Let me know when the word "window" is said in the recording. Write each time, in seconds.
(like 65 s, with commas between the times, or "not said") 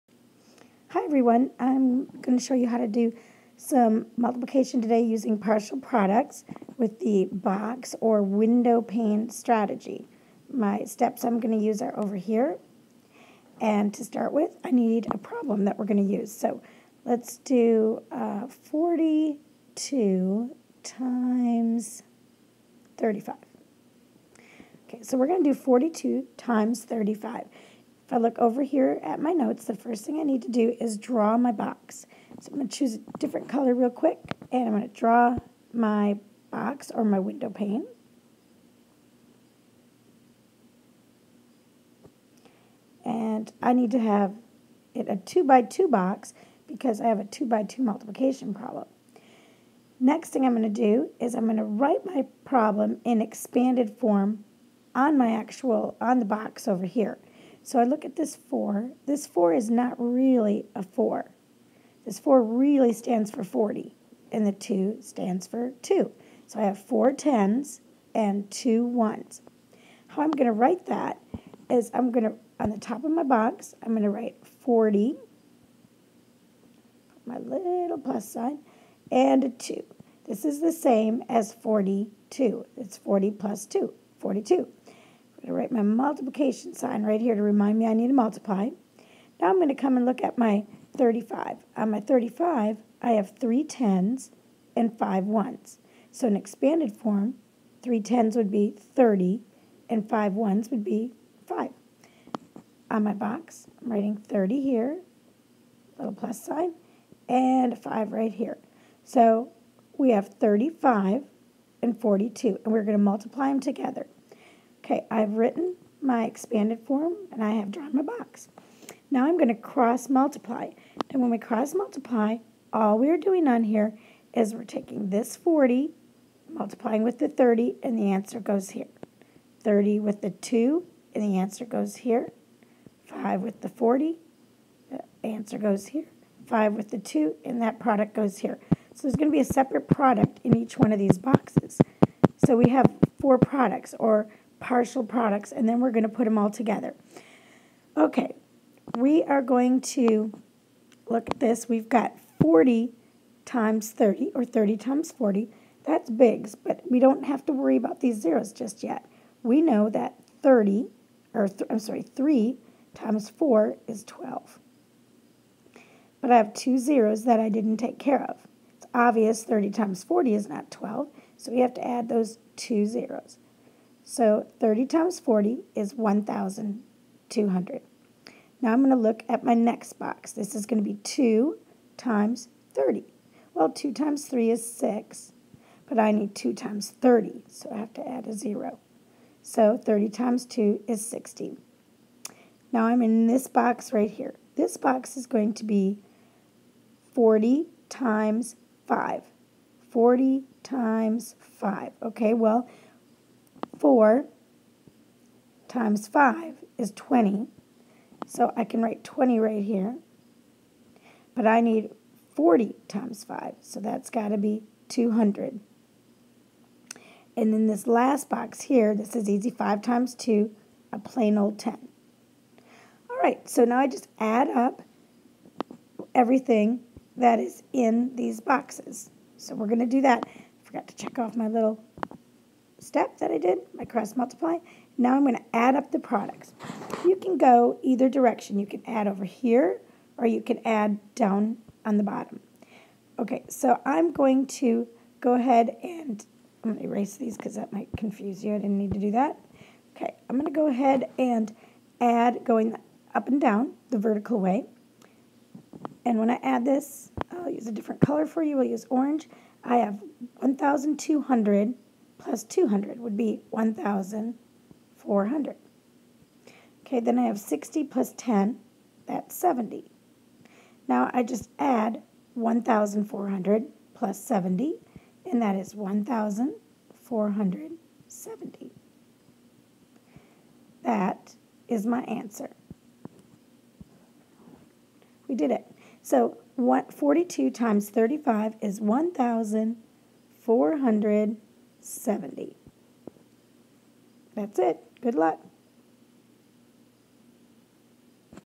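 8 s, 37 s.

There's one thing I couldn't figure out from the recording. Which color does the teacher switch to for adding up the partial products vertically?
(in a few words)
orange.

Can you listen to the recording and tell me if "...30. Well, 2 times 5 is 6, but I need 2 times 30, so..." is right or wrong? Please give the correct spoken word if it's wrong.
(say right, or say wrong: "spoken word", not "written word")
wrong: "3", not "5".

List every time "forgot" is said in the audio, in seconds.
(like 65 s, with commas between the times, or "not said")
230 s.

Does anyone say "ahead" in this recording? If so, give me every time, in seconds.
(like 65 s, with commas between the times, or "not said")
245 s, 250 s.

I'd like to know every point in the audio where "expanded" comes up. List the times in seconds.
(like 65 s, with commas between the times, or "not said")
53 s, 96 s, 116 s.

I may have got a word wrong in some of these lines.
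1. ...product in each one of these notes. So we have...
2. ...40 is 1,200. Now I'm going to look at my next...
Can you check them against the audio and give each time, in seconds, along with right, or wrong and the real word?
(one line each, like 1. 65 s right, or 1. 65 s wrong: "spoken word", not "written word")
1. 139 s wrong: "boxes", not "notes"
2. 175 s right.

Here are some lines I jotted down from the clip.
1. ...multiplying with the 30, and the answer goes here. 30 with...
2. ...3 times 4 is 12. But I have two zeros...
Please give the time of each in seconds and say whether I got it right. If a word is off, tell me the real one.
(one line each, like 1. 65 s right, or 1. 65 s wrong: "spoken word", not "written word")
1. 126 s right
2. 162 s right.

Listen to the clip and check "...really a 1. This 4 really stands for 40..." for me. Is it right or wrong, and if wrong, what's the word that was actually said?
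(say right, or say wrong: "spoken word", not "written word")
wrong: "4", not "1".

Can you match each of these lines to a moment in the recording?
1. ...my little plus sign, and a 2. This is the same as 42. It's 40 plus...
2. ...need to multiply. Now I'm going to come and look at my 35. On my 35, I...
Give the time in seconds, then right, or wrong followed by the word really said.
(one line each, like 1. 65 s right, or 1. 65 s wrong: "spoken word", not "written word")
1. 77 s right
2. 87 s right.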